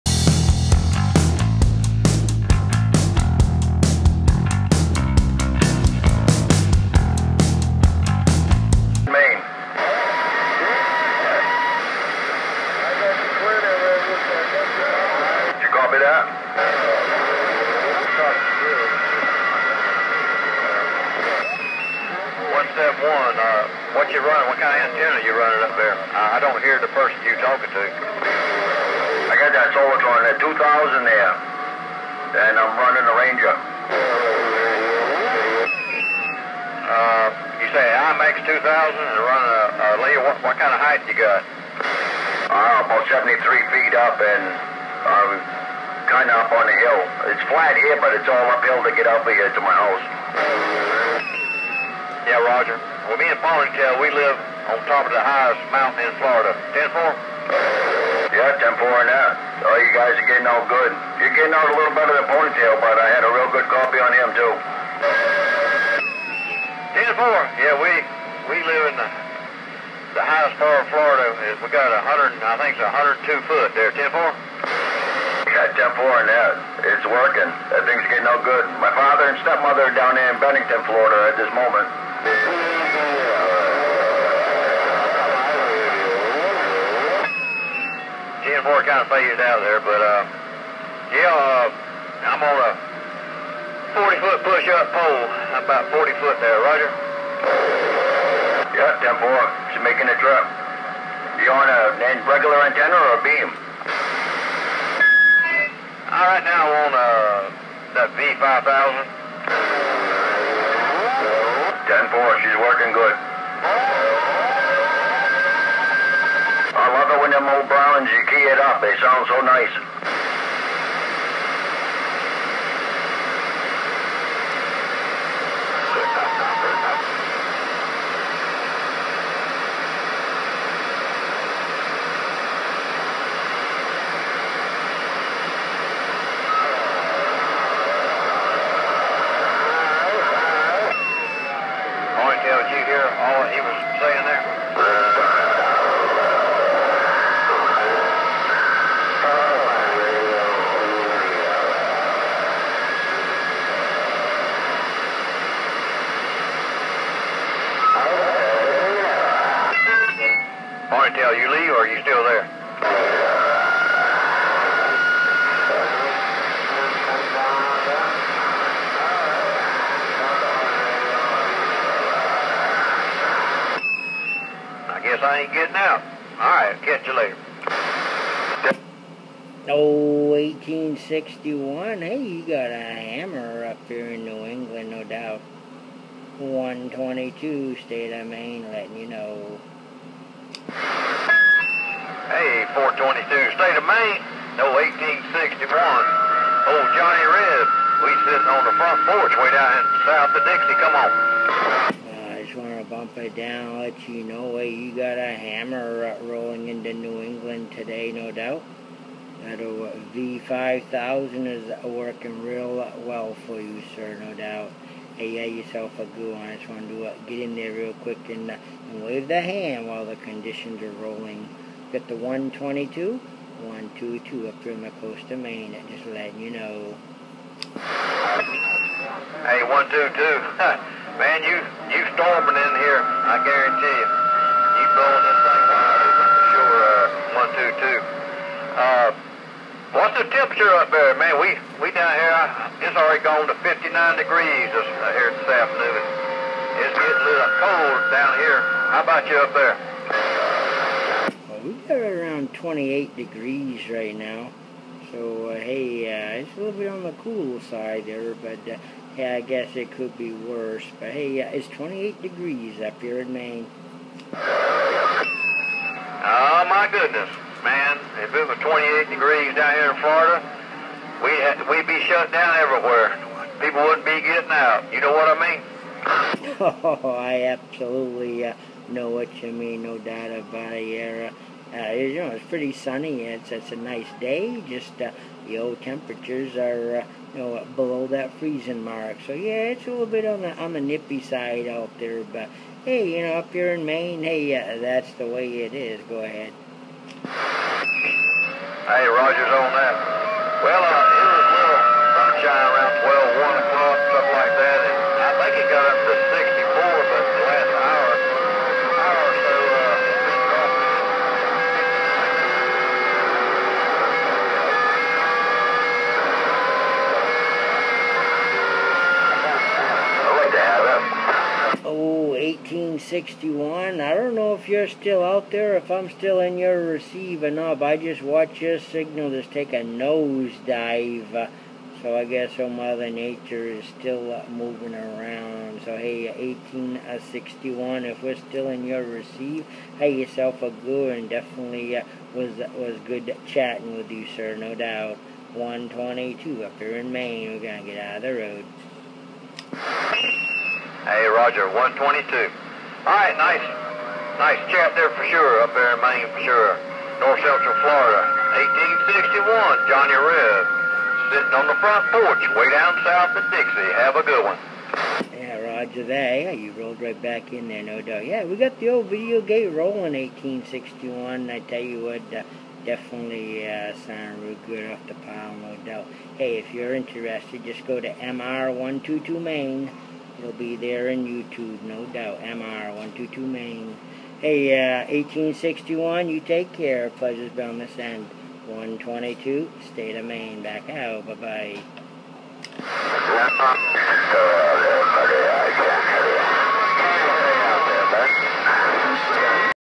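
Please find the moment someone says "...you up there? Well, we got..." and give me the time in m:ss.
4:09.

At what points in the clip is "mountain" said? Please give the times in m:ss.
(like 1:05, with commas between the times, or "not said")
0:55.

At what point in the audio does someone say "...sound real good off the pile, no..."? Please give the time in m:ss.
6:14.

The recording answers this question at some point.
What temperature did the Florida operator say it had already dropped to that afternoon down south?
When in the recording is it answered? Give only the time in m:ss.
4:03.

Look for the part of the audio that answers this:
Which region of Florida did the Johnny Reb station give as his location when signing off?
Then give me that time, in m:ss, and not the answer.
5:57.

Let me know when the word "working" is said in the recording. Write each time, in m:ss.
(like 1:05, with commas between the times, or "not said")
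1:17, 1:52, 3:31.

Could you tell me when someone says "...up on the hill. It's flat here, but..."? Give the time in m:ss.
0:46.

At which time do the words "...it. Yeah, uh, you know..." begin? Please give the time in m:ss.
4:40.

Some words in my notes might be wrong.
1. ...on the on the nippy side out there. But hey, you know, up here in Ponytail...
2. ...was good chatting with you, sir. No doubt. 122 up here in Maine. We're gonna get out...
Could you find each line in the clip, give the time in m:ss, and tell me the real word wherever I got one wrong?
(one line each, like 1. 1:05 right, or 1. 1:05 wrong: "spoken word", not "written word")
1. 4:50 wrong: "Maine", not "Ponytail"
2. 5:42 right.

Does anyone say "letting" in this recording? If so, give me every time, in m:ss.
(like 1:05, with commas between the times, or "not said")
3:08, 3:46.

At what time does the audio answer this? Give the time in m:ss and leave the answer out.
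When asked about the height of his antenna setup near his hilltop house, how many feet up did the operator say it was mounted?
0:43.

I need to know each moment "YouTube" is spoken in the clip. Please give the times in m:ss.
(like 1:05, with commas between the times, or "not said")
6:21.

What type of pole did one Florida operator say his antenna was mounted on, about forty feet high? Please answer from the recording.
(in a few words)
push up pole.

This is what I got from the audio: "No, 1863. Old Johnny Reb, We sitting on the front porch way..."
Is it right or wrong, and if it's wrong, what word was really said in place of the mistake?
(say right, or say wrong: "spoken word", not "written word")
wrong: "1861", not "1863".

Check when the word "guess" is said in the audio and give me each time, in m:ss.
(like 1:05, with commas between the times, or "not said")
2:55, 4:19, 5:32.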